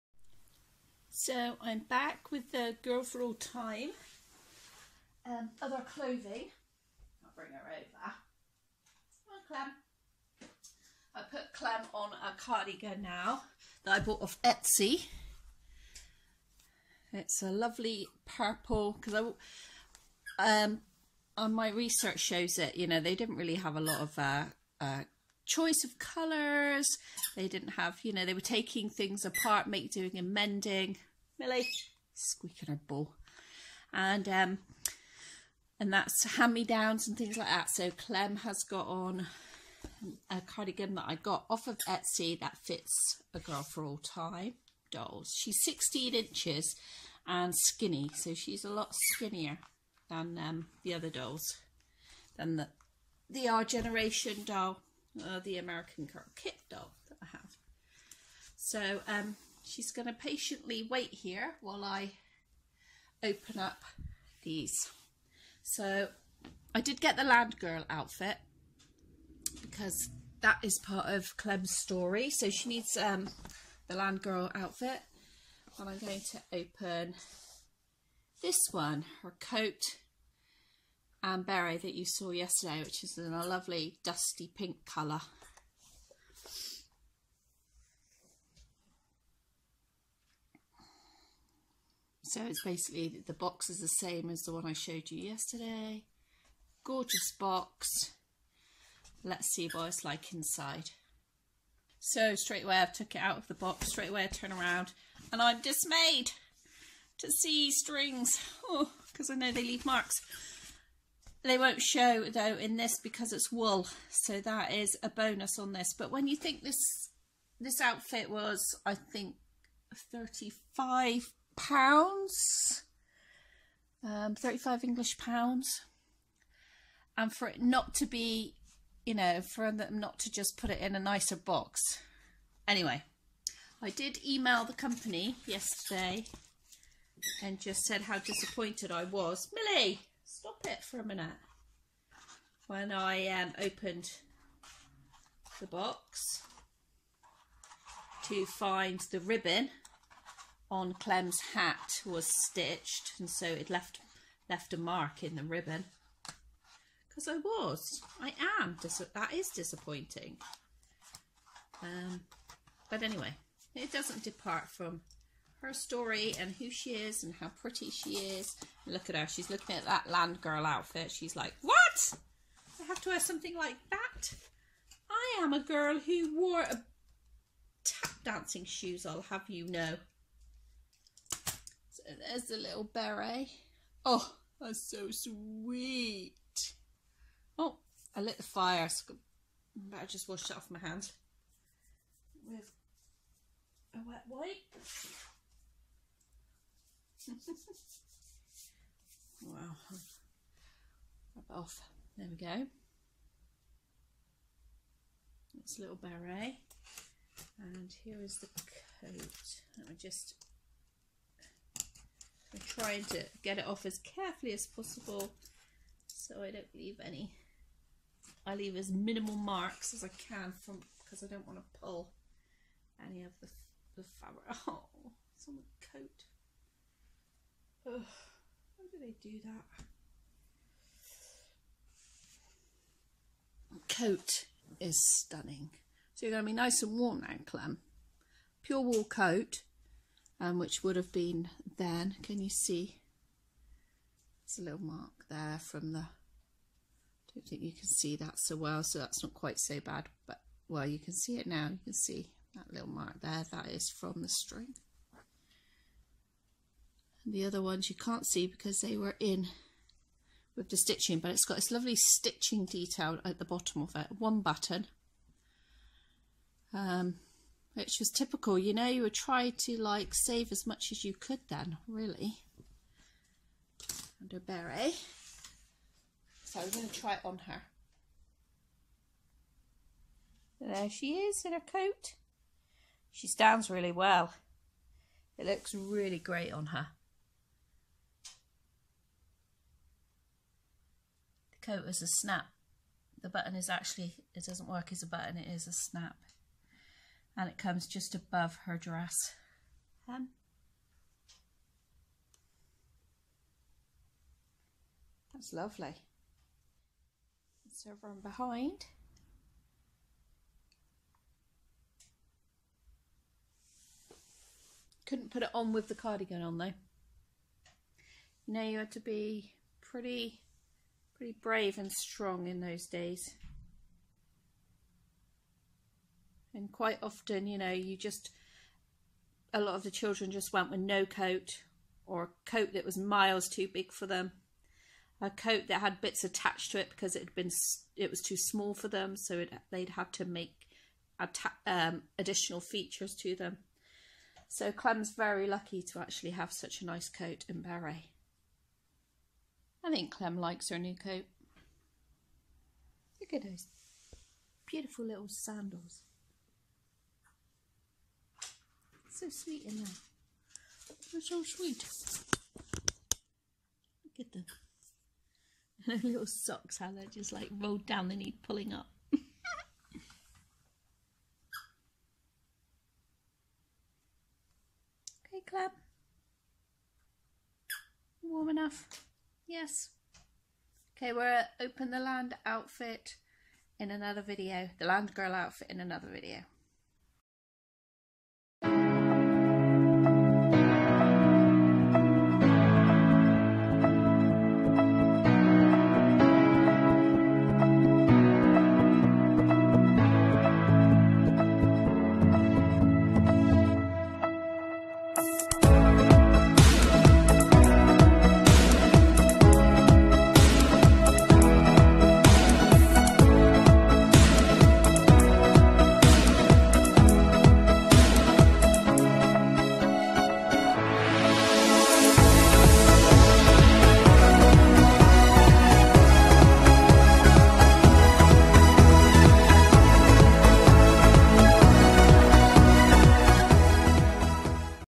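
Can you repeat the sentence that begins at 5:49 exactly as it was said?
I think Clem likes her new coat.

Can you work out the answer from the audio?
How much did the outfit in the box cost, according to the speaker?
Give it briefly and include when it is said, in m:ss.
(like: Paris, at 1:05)
35 pounds, at 2:00.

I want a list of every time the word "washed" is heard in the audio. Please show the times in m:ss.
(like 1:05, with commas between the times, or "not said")
3:10.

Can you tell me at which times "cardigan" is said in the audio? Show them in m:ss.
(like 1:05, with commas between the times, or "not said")
0:12, 0:40, 5:15.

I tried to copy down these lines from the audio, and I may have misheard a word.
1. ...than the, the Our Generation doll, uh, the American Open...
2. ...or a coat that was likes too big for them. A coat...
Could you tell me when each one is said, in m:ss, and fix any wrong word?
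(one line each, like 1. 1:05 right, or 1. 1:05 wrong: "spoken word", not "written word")
1. 0:52 wrong: "Girl", not "Open"
2. 5:32 wrong: "miles", not "likes".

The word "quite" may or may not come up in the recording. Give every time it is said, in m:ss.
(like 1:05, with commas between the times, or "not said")
4:09, 5:26.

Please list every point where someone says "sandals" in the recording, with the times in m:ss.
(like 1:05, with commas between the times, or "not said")
5:55.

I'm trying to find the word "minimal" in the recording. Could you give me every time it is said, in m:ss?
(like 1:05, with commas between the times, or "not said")
3:38.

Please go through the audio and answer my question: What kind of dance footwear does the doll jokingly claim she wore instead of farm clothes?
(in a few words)
tap dancing shoes.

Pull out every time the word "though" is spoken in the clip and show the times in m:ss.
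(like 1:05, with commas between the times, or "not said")
1:52, 5:16.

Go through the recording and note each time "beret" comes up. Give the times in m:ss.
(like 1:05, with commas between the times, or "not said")
1:21, 3:02, 3:25, 4:34, 5:47.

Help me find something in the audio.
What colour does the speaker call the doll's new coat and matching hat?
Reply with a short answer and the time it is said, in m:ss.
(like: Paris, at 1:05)
dusty pink, at 1:24.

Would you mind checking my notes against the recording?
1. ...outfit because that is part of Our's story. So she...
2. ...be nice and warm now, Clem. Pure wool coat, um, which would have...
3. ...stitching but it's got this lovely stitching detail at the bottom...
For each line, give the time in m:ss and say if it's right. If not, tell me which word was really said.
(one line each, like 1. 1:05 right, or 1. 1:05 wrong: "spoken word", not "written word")
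1. 1:07 wrong: "Clem", not "Our"
2. 3:56 right
3. 4:20 right.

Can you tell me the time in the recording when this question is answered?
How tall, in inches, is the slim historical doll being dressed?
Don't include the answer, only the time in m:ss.
0:45.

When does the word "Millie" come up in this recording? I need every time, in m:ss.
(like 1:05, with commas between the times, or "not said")
0:31, 2:19.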